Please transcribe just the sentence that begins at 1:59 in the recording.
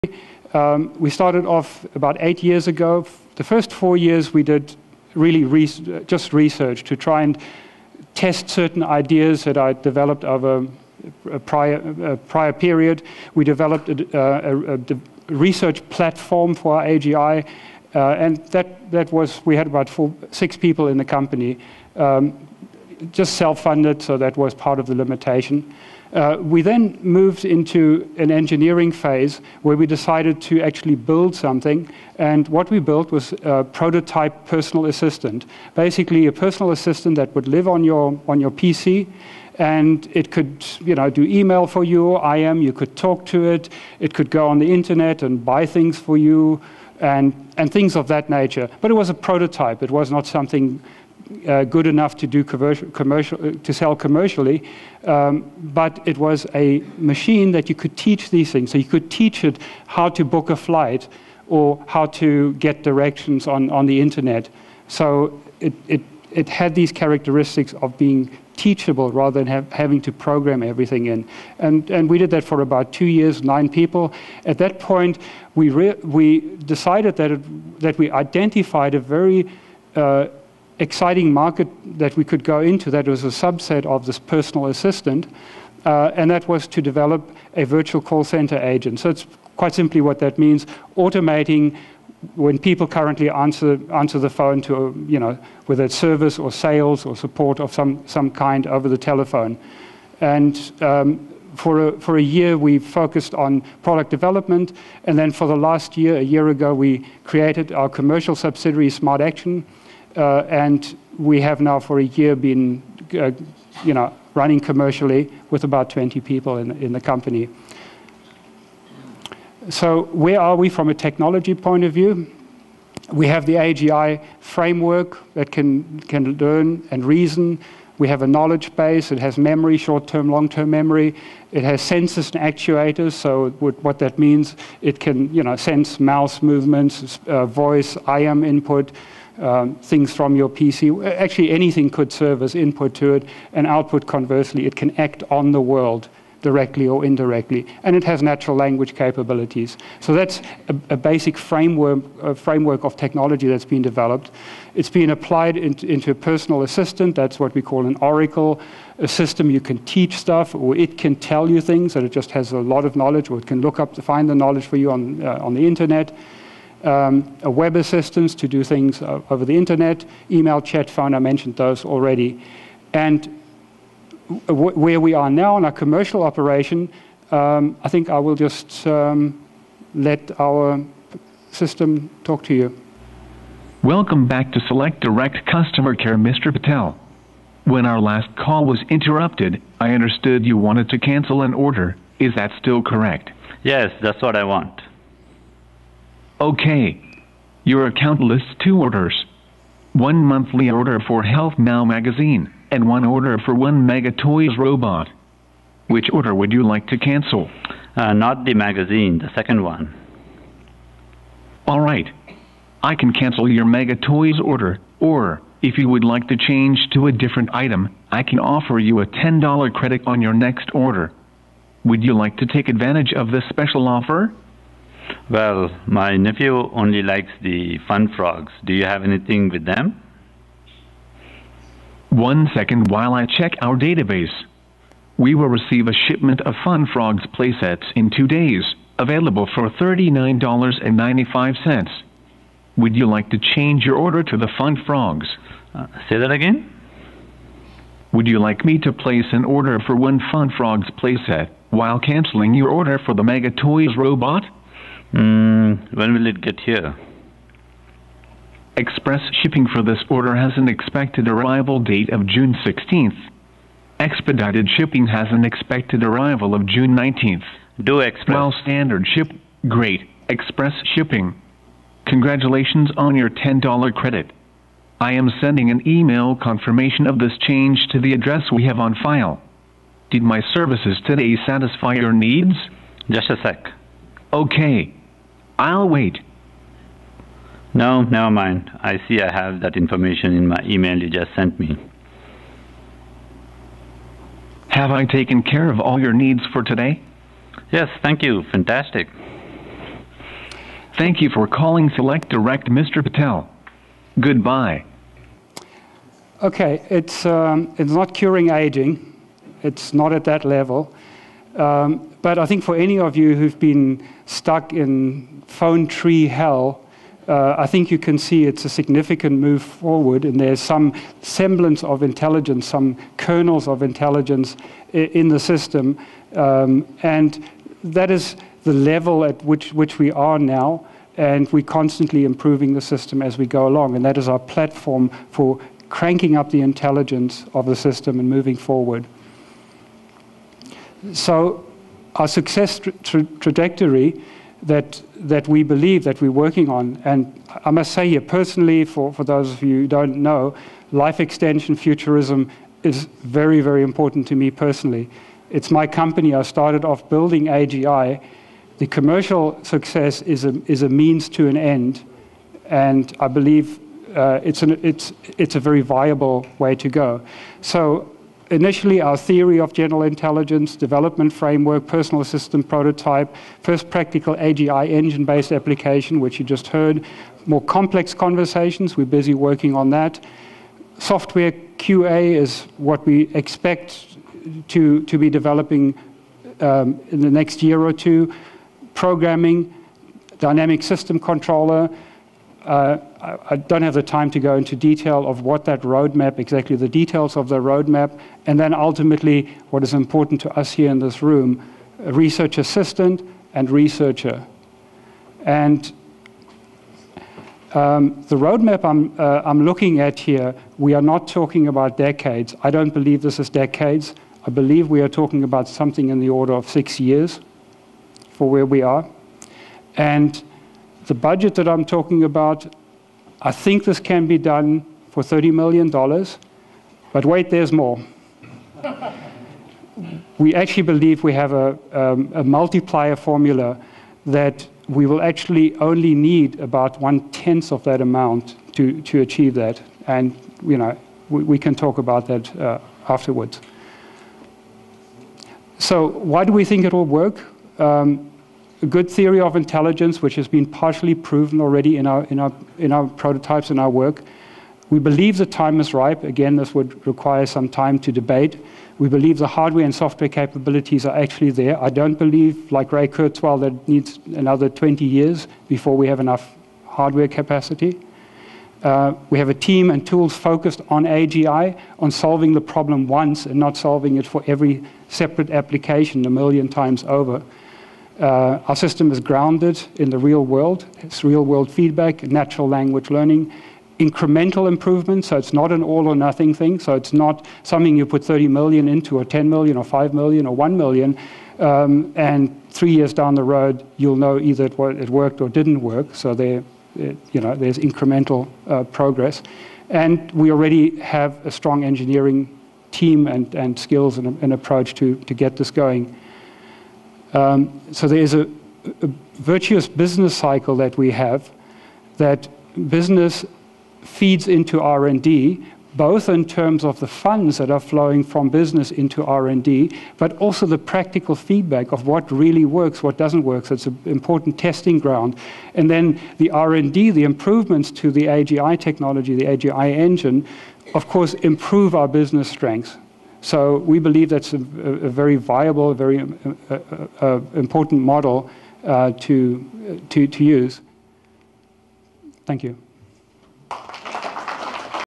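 So where are we from a technology point of view?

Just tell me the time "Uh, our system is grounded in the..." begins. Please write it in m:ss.
7:58.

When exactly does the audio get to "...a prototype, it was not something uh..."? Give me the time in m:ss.
0:49.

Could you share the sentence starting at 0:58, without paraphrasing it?
So you could teach it how to book a flight or how to get directions on, on the internet.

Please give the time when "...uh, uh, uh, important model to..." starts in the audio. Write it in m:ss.
8:56.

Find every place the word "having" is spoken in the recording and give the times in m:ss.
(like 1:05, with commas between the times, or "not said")
1:09.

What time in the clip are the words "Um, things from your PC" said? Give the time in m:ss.
2:19.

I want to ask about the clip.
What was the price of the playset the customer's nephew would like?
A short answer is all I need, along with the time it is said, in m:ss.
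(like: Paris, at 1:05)
$39.95, at 3:59.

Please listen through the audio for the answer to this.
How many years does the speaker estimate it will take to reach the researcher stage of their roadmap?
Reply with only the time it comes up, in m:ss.
6:56.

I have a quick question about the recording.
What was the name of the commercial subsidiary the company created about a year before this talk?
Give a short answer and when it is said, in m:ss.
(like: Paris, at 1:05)
Smart Action, at 1:48.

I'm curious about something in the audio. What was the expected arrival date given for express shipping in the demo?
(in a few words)
June 16.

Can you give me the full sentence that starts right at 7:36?
Again, this would require some time to debate.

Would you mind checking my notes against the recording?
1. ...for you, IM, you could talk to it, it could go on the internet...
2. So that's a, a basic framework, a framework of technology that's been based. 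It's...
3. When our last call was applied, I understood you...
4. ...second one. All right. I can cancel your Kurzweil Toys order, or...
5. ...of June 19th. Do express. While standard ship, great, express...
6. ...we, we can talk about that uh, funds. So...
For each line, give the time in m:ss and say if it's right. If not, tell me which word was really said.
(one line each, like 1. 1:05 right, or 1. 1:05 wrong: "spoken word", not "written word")
1. 0:41 right
2. 2:29 wrong: "developed", not "based"
3. 3:07 wrong: "interrupted", not "applied"
4. 3:29 wrong: "Mega", not "Kurzweil"
5. 4:26 right
6. 7:21 wrong: "afterwards", not "funds".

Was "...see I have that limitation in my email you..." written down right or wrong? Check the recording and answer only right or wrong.
wrong.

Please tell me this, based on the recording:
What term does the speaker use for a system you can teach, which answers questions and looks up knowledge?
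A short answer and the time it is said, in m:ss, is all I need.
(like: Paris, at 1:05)
oracle, at 2:38.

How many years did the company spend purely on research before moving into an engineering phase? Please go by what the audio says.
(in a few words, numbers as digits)
4.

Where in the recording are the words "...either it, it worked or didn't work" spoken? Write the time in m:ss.
8:14.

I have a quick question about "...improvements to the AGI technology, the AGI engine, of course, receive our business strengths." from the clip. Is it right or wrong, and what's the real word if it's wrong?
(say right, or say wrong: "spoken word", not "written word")
wrong: "improve", not "receive".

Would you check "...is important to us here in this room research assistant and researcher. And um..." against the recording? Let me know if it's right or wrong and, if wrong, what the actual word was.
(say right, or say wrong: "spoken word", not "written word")
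right.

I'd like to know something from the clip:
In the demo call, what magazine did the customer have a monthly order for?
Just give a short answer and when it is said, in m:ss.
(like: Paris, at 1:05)
Health Now, at 3:21.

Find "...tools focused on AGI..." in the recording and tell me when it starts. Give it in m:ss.
7:50.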